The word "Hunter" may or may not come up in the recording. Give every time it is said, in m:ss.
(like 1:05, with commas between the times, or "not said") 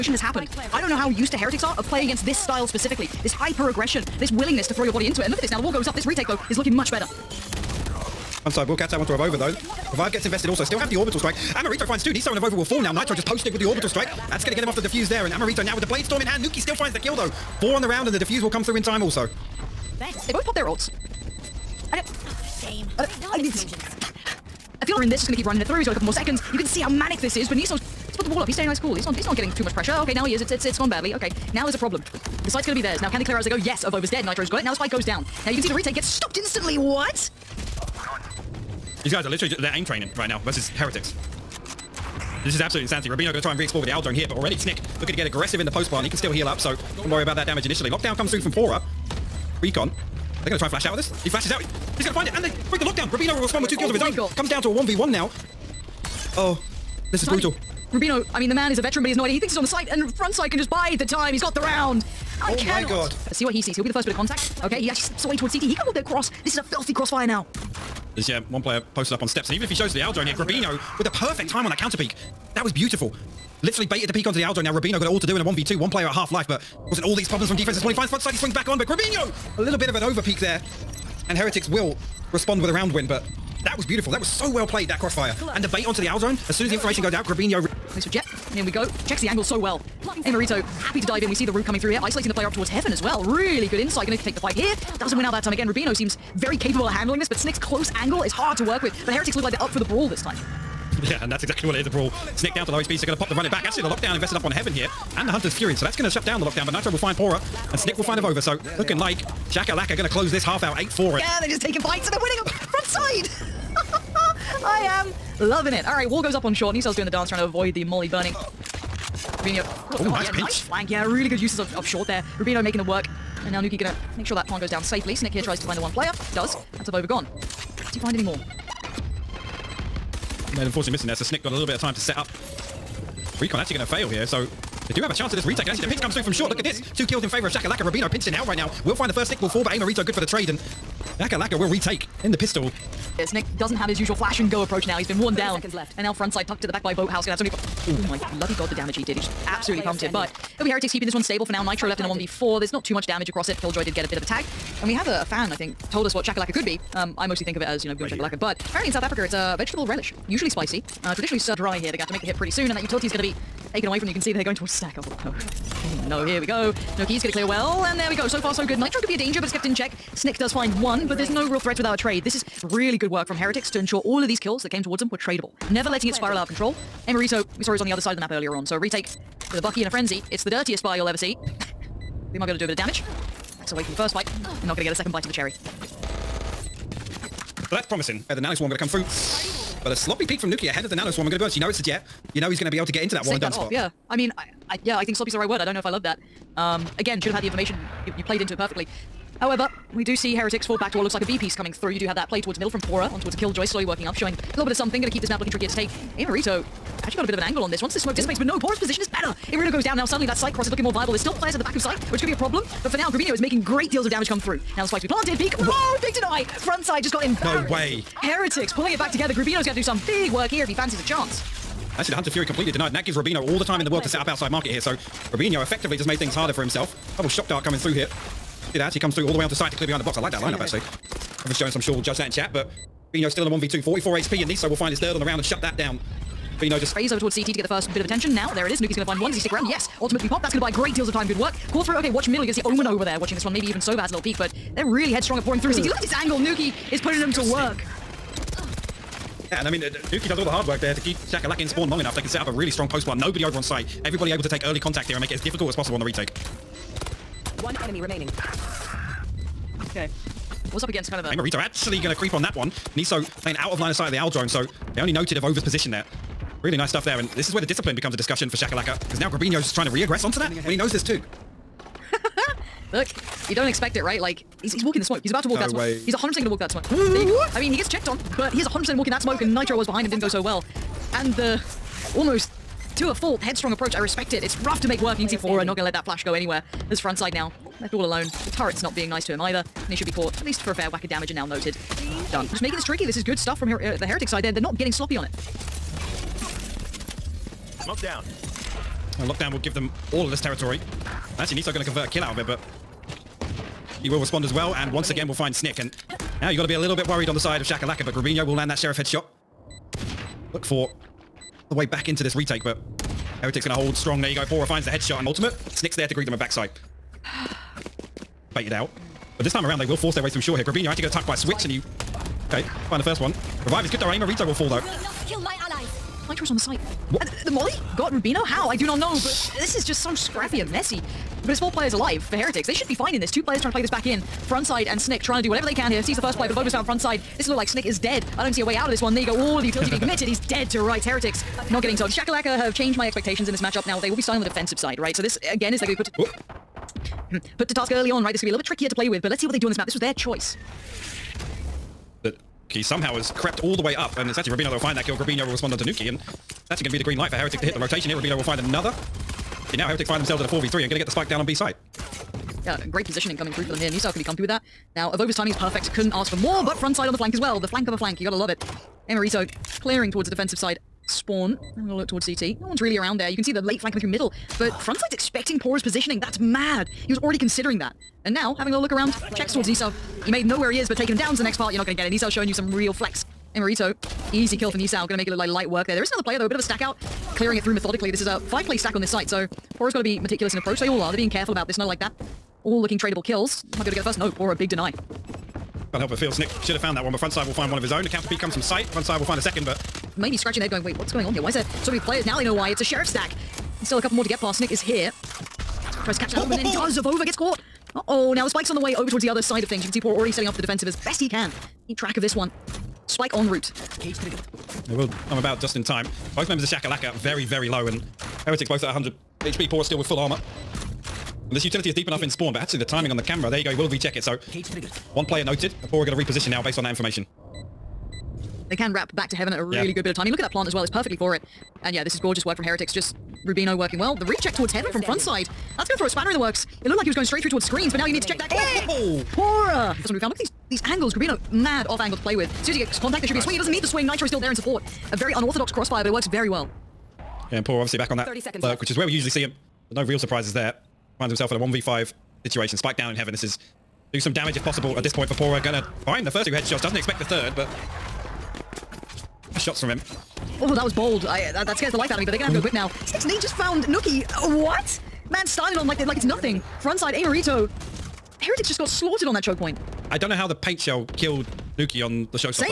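1:45, 3:42.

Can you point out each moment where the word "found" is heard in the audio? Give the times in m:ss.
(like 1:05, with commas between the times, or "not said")
5:36, 6:36, 7:20, 7:43.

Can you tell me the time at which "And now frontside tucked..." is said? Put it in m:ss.
2:25.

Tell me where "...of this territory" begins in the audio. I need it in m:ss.
5:00.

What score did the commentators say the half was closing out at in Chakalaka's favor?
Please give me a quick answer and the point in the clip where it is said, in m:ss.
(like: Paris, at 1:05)
8-4, at 1:50.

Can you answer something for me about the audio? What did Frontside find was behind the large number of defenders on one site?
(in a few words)
a sheriff stack.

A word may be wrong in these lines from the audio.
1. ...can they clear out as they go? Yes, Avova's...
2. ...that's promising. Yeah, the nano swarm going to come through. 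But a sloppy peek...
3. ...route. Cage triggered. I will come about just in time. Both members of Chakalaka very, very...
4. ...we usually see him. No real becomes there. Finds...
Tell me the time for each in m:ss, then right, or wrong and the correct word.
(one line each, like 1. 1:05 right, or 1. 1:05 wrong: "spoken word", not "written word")
1. 0:33 right
2. 3:07 right
3. 6:53 right
4. 7:29 wrong: "surprises", not "becomes".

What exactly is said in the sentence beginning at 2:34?
And we have a, a fan, I think, told us what chakalaka could be.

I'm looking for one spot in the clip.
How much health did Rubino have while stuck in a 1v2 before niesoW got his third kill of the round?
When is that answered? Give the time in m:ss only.
3:53.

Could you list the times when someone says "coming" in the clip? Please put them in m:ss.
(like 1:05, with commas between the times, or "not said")
1:31, 3:21, 3:47, 6:03, 6:13.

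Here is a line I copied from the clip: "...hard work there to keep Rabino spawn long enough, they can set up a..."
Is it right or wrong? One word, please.
wrong.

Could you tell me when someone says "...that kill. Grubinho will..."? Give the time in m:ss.
5:54.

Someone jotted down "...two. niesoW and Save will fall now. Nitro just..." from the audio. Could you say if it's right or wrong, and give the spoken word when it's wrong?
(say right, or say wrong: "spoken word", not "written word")
wrong: "Avova", not "Save".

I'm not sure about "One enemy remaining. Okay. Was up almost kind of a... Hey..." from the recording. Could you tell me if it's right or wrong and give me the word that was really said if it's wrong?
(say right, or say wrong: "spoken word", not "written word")
wrong: "against", not "almost".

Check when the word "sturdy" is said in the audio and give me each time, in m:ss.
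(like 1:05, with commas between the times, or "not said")
not said.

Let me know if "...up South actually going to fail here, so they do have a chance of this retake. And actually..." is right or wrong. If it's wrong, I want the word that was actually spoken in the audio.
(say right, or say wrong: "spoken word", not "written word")
wrong: "Recon", not "South".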